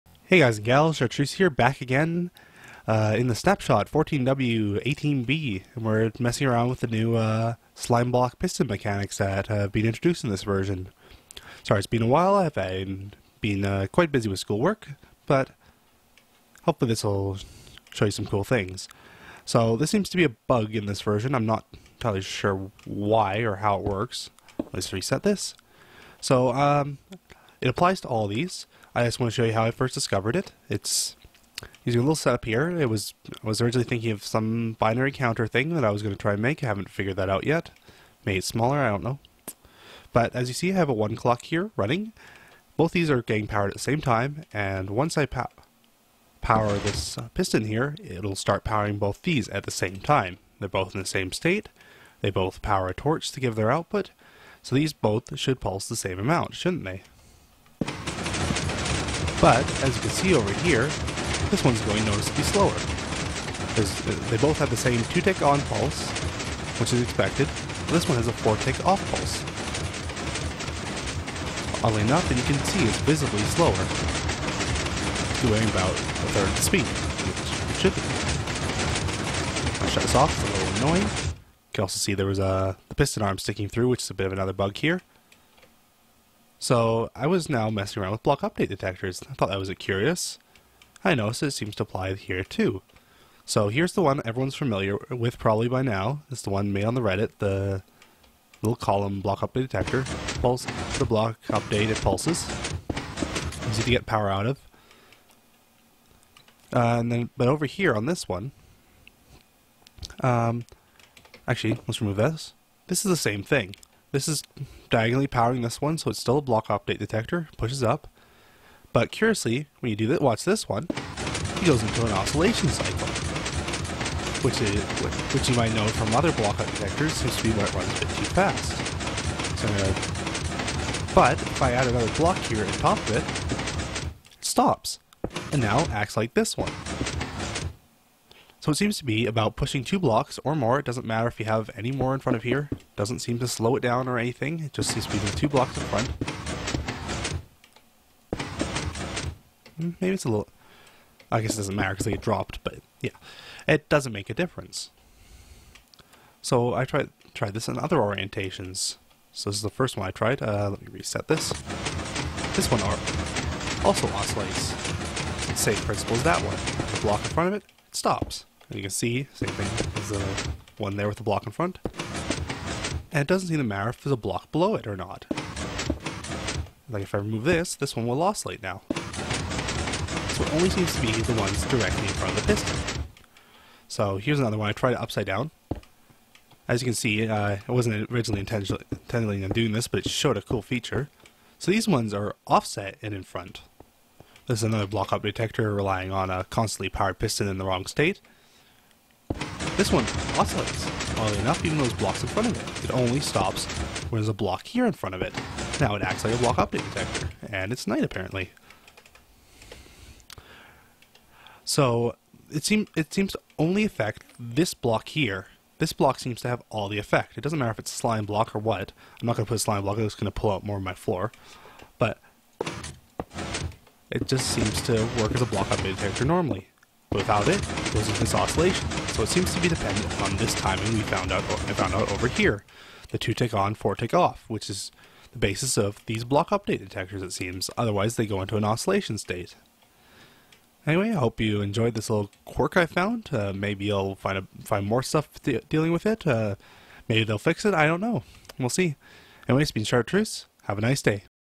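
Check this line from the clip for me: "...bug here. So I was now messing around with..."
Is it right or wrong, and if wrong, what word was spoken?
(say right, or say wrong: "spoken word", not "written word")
right.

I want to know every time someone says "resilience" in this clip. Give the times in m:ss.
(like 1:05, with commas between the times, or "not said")
not said.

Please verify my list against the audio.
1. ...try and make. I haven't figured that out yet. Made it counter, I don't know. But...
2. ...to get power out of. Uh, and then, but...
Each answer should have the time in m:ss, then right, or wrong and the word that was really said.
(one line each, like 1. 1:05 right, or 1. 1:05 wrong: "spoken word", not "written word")
1. 0:36 wrong: "smaller", not "counter"
2. 1:43 right.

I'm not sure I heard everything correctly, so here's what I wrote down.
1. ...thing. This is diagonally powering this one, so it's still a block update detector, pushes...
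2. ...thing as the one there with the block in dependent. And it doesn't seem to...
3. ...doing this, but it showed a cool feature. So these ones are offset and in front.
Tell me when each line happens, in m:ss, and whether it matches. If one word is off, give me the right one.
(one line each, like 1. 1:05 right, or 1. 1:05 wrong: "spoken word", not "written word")
1. 1:53 right
2. 2:49 wrong: "front", not "dependent"
3. 3:09 right.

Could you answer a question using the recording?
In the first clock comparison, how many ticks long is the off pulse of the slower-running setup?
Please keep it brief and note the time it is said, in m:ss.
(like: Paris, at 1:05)
4, at 1:08.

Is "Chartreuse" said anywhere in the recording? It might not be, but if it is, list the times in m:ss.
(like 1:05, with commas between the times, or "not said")
0:00, 4:09.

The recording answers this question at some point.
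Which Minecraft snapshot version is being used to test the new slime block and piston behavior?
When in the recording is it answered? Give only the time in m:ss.
0:03.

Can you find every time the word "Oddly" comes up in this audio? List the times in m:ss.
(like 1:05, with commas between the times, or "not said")
1:11, 3:21.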